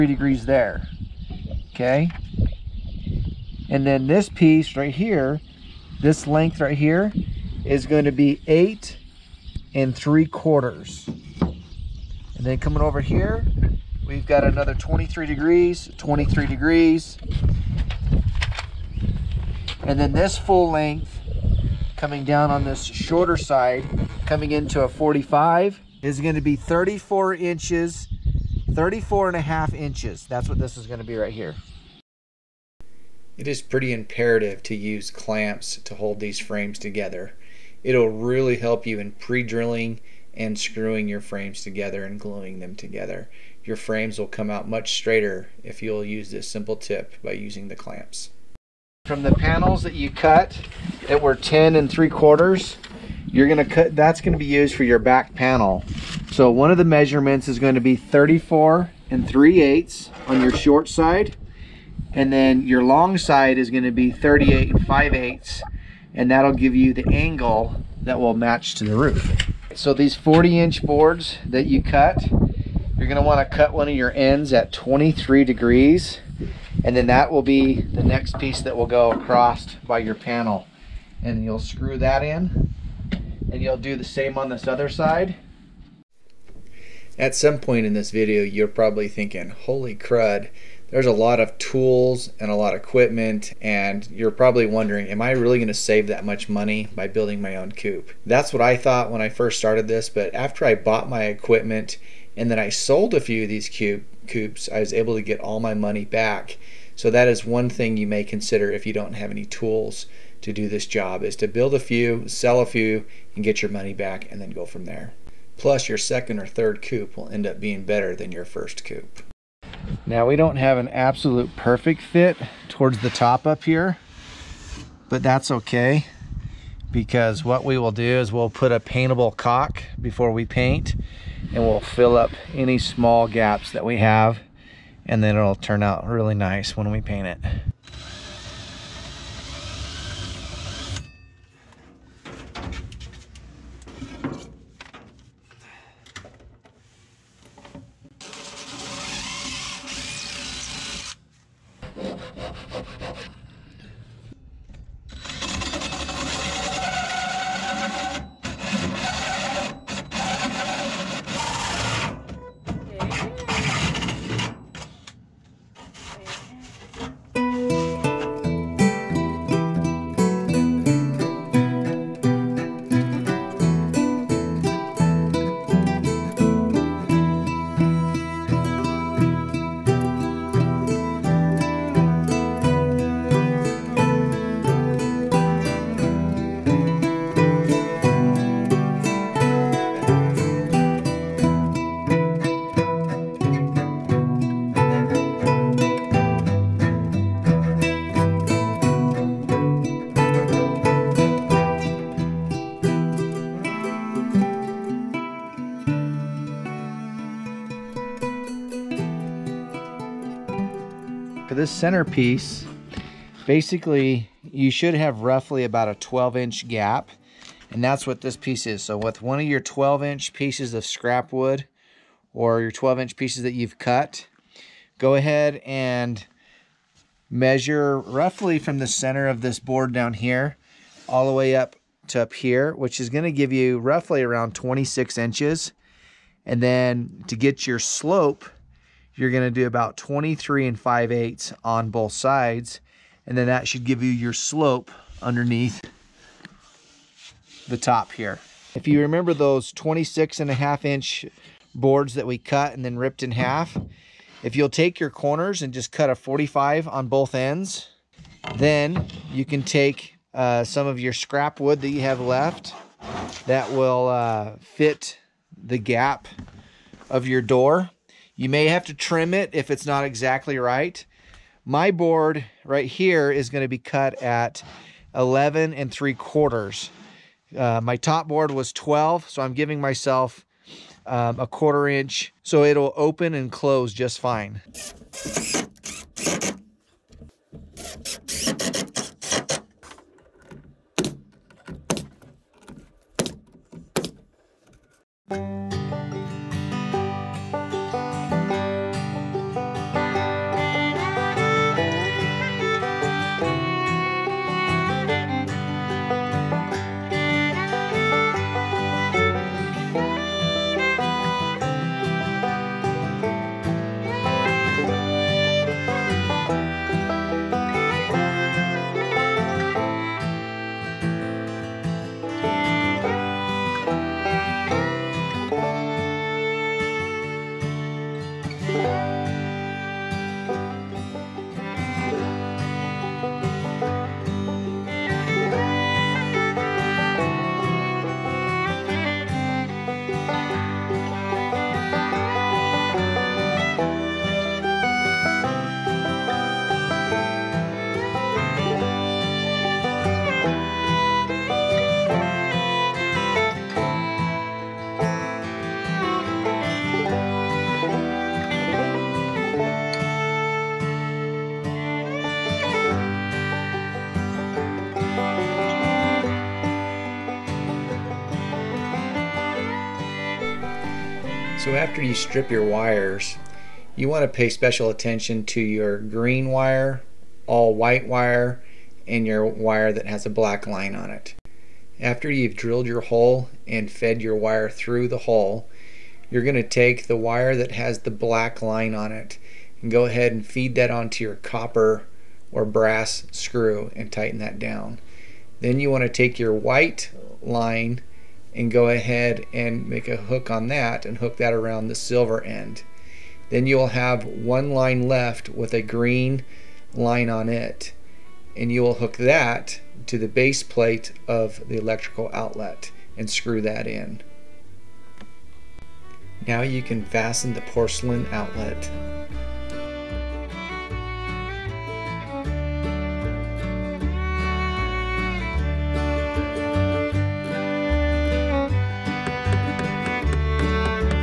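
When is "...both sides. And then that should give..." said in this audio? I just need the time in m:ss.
4:01.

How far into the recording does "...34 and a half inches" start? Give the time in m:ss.
0:28.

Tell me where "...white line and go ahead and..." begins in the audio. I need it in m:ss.
6:36.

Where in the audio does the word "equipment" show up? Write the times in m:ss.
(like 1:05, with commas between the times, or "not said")
1:32, 1:41.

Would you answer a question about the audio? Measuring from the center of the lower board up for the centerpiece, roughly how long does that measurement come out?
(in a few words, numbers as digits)
26 inches.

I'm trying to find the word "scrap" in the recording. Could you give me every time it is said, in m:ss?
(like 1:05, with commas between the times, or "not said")
3:40, 4:21.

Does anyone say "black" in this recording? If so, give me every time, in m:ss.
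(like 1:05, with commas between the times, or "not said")
6:20, 6:28.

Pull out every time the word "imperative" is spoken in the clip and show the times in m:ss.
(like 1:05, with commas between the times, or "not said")
0:33.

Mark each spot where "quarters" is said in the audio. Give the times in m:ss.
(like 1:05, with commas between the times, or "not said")
0:10, 0:52, 4:36, 4:41.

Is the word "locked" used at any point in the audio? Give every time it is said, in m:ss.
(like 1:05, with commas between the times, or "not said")
not said.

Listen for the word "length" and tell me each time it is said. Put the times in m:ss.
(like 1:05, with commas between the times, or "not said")
0:06, 0:20.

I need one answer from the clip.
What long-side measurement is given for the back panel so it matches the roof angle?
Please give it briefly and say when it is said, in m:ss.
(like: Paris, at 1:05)
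38 5/8, at 1:04.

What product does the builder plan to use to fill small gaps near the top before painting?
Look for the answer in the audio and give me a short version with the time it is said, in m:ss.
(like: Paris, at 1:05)
paintable caulk, at 2:08.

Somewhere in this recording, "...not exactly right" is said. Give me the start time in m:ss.
4:29.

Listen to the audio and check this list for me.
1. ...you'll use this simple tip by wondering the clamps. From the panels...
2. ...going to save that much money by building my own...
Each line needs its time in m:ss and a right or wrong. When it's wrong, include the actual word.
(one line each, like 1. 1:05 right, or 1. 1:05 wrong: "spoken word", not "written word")
1. 0:45 wrong: "using", not "wondering"
2. 1:35 right.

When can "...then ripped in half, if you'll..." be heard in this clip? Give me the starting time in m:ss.
4:12.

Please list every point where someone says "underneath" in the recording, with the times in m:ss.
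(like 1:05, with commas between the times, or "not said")
4:05.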